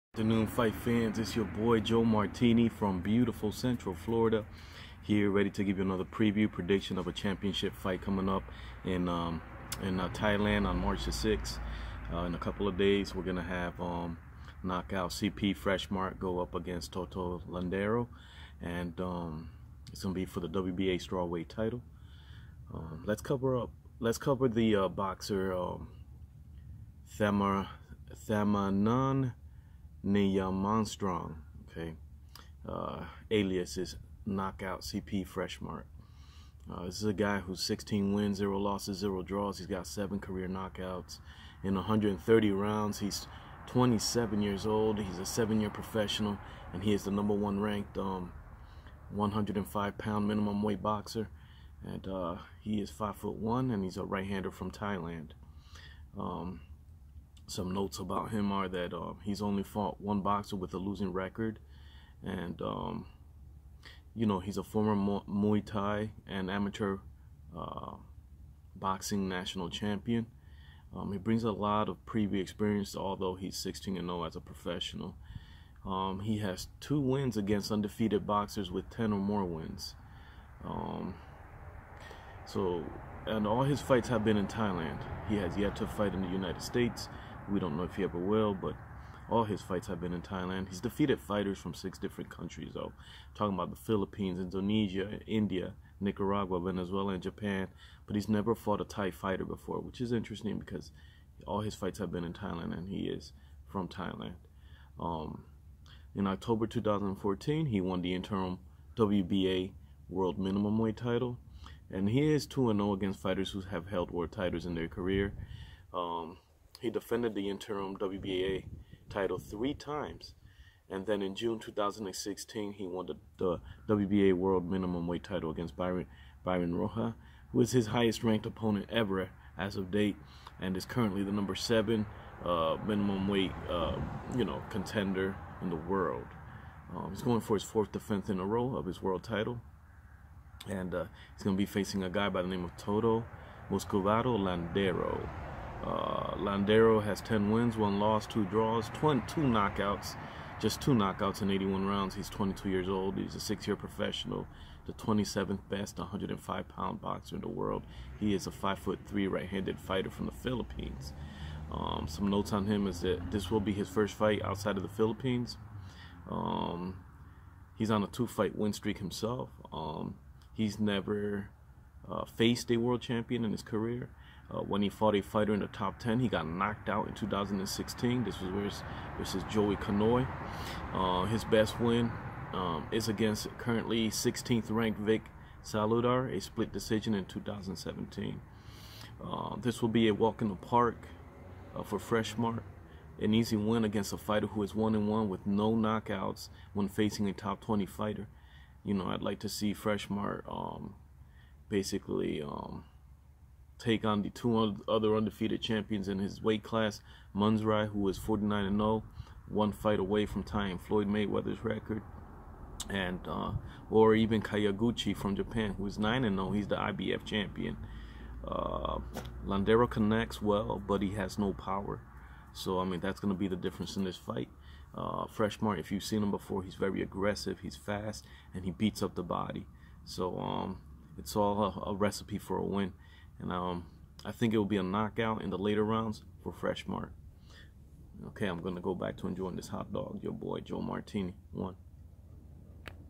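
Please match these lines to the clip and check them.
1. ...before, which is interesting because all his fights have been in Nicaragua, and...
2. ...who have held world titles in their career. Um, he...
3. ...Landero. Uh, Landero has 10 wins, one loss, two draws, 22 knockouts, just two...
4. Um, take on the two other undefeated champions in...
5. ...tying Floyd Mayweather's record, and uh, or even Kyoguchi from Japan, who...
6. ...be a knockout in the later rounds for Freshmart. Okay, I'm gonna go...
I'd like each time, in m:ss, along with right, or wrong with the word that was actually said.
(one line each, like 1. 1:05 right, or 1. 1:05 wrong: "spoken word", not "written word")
1. 1:39 wrong: "Thailand", not "Nicaragua"
2. 1:53 right
3. 2:24 right
4. 3:22 right
5. 3:30 right
6. 3:54 right.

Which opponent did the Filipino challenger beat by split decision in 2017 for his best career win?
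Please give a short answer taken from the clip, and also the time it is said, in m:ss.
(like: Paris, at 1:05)
Vic Saludar, at 3:04.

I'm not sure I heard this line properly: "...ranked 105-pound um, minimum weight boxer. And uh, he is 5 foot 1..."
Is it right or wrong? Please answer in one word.
right.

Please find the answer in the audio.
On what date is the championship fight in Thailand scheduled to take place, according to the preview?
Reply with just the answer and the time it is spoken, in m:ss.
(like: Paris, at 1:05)
March 6, at 0:10.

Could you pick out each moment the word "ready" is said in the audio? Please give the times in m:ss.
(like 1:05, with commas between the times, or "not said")
0:05.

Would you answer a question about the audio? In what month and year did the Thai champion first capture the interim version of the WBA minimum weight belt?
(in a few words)
October 2014.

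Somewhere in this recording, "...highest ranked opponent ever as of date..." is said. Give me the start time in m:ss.
2:07.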